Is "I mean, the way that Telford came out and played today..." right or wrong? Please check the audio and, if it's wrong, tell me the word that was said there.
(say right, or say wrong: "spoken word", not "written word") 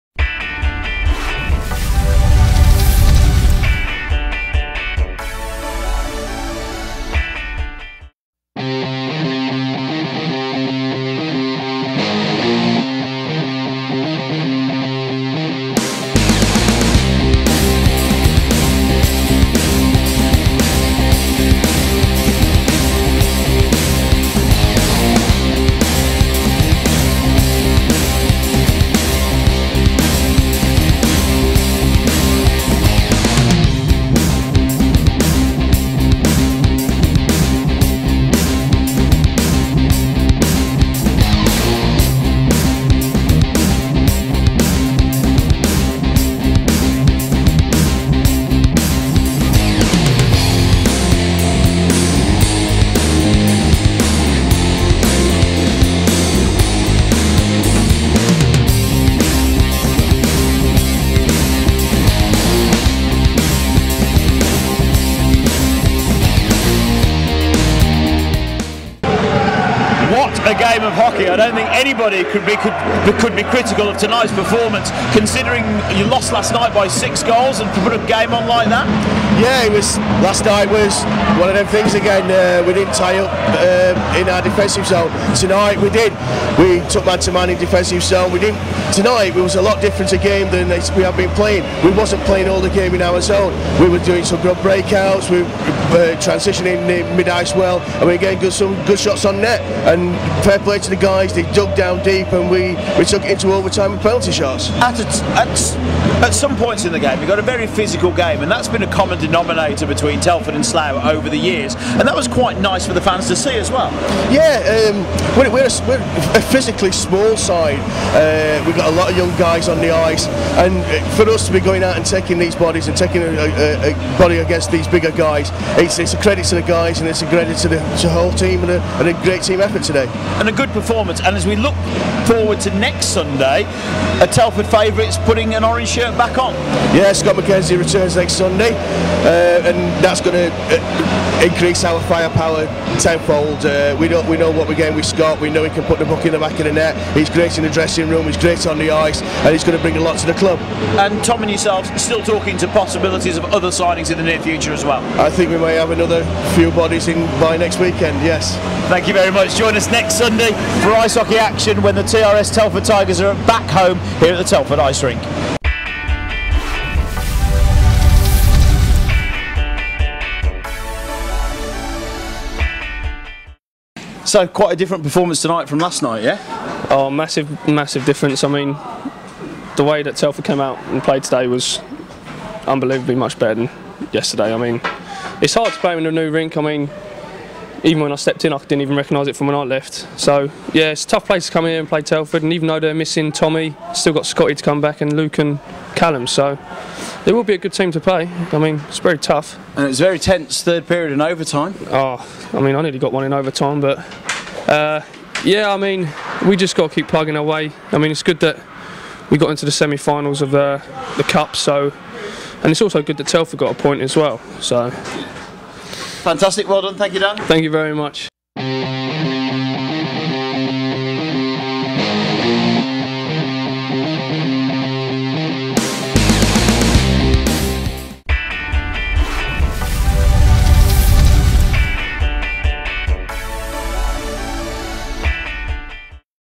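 right.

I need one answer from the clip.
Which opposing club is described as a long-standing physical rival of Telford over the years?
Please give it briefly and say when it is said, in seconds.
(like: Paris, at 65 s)
Slough, at 110 s.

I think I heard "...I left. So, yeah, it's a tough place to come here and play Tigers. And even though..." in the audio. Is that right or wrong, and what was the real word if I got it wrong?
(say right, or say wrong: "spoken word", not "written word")
wrong: "Telford", not "Tigers".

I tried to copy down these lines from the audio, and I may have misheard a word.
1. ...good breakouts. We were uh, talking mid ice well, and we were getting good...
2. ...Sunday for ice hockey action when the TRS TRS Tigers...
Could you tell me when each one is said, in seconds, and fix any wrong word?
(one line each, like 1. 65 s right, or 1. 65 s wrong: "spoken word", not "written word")
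1. 94 s wrong: "transitioning", not "talking"
2. 160 s wrong: "Telford", not "TRS".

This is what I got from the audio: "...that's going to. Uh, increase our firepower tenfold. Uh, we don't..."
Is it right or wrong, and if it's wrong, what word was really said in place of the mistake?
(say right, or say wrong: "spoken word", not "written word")
right.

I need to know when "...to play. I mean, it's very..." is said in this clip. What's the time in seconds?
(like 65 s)
197 s.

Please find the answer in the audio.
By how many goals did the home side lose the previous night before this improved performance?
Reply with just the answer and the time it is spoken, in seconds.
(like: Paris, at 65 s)
6, at 76 s.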